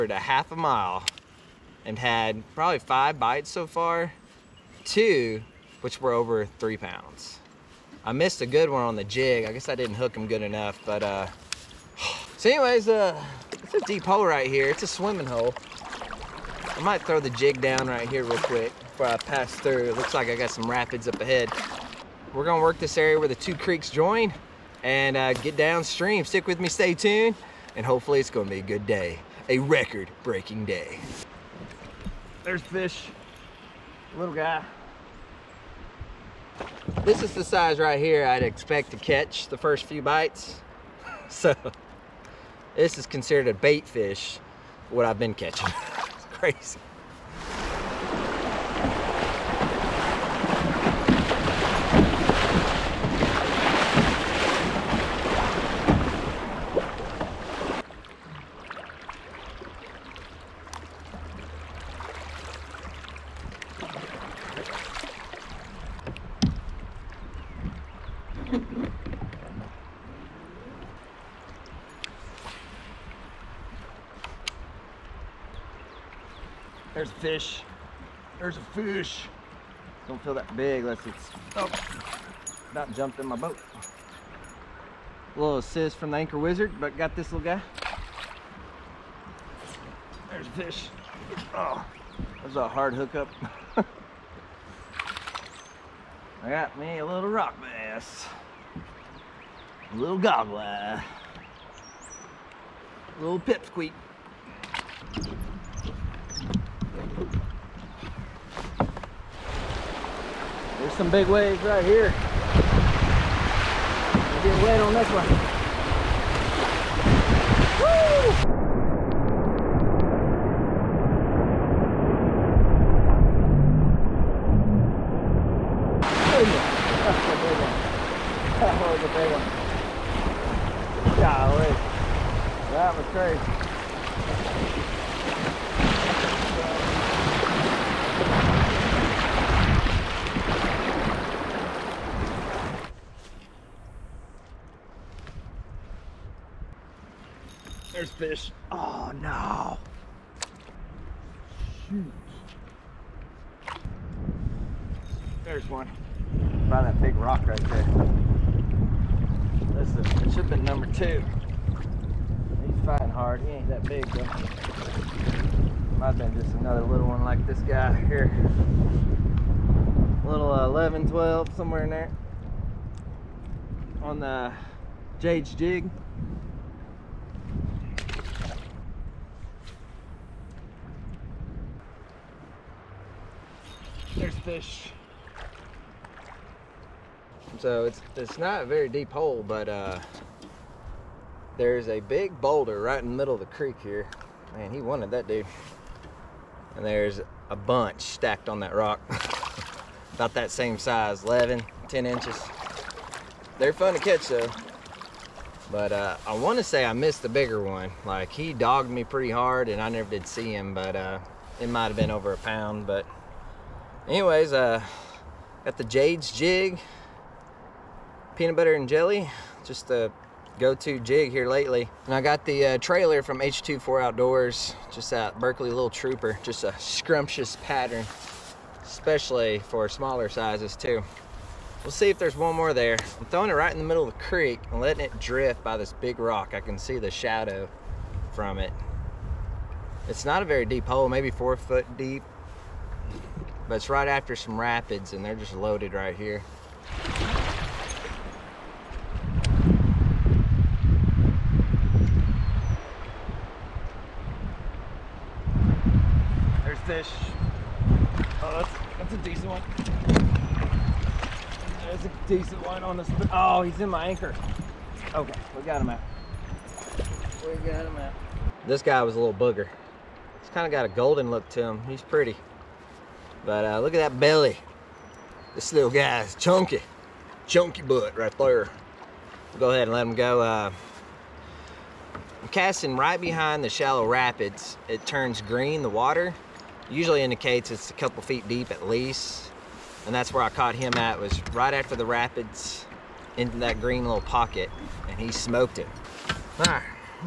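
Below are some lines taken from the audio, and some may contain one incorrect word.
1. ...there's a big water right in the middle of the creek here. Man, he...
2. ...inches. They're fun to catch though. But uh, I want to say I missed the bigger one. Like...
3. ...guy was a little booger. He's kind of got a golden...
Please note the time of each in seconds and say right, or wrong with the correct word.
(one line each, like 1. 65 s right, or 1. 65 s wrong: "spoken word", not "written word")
1. 191 s wrong: "boulder", not "water"
2. 202 s right
3. 268 s right.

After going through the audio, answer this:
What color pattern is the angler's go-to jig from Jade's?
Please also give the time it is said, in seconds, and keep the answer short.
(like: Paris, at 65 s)
peanut butter and jelly, at 218 s.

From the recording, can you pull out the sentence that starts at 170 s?
Little uh, 11, 12, somewhere in there.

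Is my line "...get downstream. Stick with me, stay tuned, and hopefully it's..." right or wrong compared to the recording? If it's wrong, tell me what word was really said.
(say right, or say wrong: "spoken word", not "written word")
right.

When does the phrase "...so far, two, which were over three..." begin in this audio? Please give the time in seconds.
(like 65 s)
3 s.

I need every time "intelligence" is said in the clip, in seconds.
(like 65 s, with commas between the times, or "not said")
not said.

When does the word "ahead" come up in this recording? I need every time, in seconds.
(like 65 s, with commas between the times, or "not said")
21 s, 279 s.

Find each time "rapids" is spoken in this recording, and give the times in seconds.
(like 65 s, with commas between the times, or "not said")
20 s, 244 s, 284 s, 292 s.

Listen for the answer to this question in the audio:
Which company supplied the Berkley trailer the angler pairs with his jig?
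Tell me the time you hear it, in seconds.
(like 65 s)
223 s.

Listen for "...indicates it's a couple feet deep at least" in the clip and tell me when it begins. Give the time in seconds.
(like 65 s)
287 s.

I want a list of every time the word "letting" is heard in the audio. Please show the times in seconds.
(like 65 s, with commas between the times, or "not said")
234 s.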